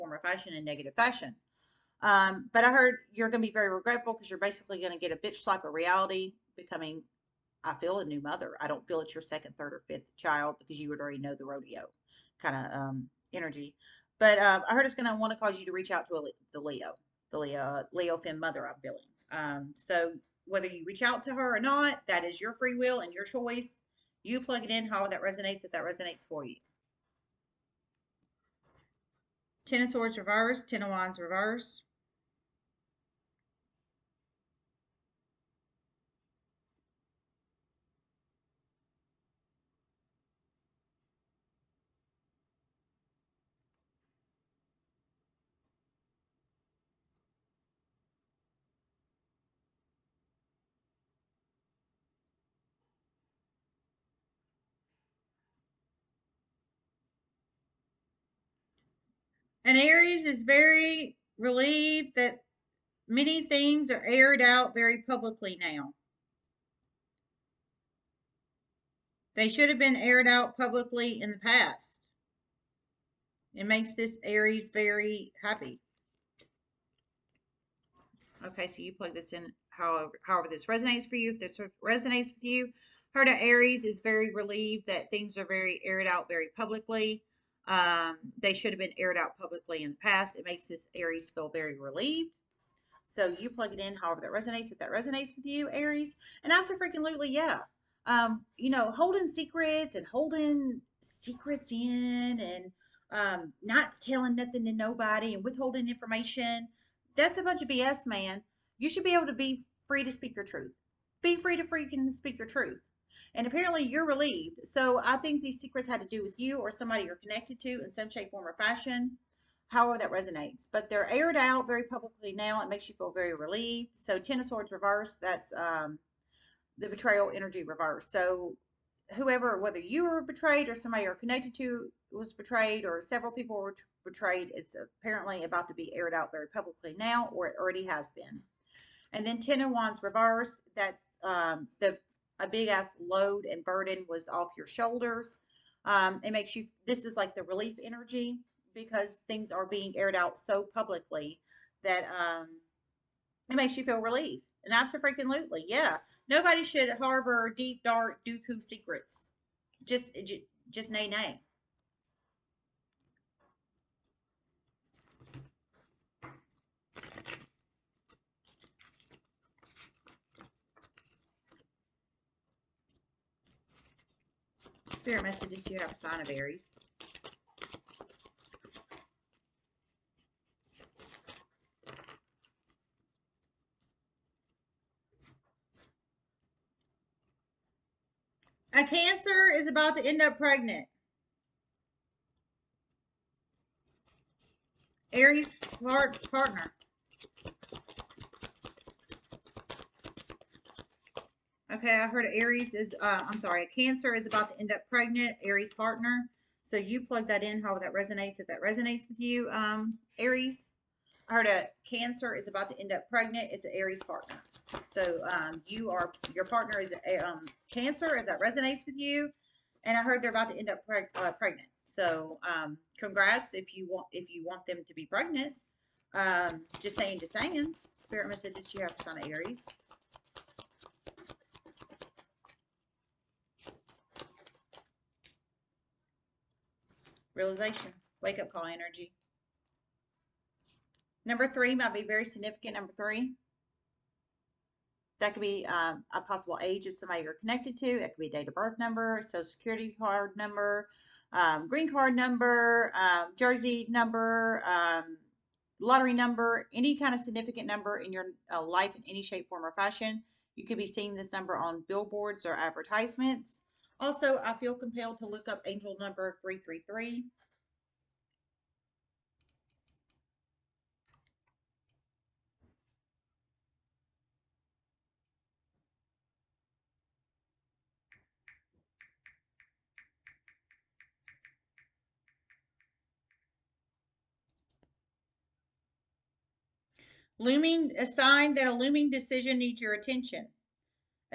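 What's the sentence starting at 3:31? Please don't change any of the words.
I heard a Cancer is about to end up pregnant.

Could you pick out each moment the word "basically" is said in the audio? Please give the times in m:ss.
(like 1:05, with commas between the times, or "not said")
0:04.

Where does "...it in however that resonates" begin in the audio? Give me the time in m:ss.
1:33.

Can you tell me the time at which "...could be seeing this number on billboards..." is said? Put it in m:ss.
4:20.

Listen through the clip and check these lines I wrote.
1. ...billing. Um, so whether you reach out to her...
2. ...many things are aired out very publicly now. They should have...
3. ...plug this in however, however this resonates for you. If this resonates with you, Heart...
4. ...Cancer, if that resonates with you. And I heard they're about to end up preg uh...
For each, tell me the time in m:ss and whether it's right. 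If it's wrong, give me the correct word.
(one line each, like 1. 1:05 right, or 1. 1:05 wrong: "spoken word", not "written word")
1. 0:18 right
2. 1:03 right
3. 1:18 right
4. 3:37 right.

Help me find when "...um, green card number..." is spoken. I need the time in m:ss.
4:11.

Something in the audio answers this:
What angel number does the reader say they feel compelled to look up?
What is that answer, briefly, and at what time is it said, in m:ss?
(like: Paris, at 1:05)
333, at 4:26.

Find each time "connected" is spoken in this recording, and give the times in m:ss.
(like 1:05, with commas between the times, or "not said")
1:57, 2:11, 4:07.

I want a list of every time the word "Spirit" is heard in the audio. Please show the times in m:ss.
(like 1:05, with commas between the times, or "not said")
2:54, 3:47.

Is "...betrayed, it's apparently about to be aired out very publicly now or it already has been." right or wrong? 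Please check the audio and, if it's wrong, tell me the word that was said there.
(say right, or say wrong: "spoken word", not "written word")
right.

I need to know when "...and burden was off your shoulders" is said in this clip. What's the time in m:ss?
2:23.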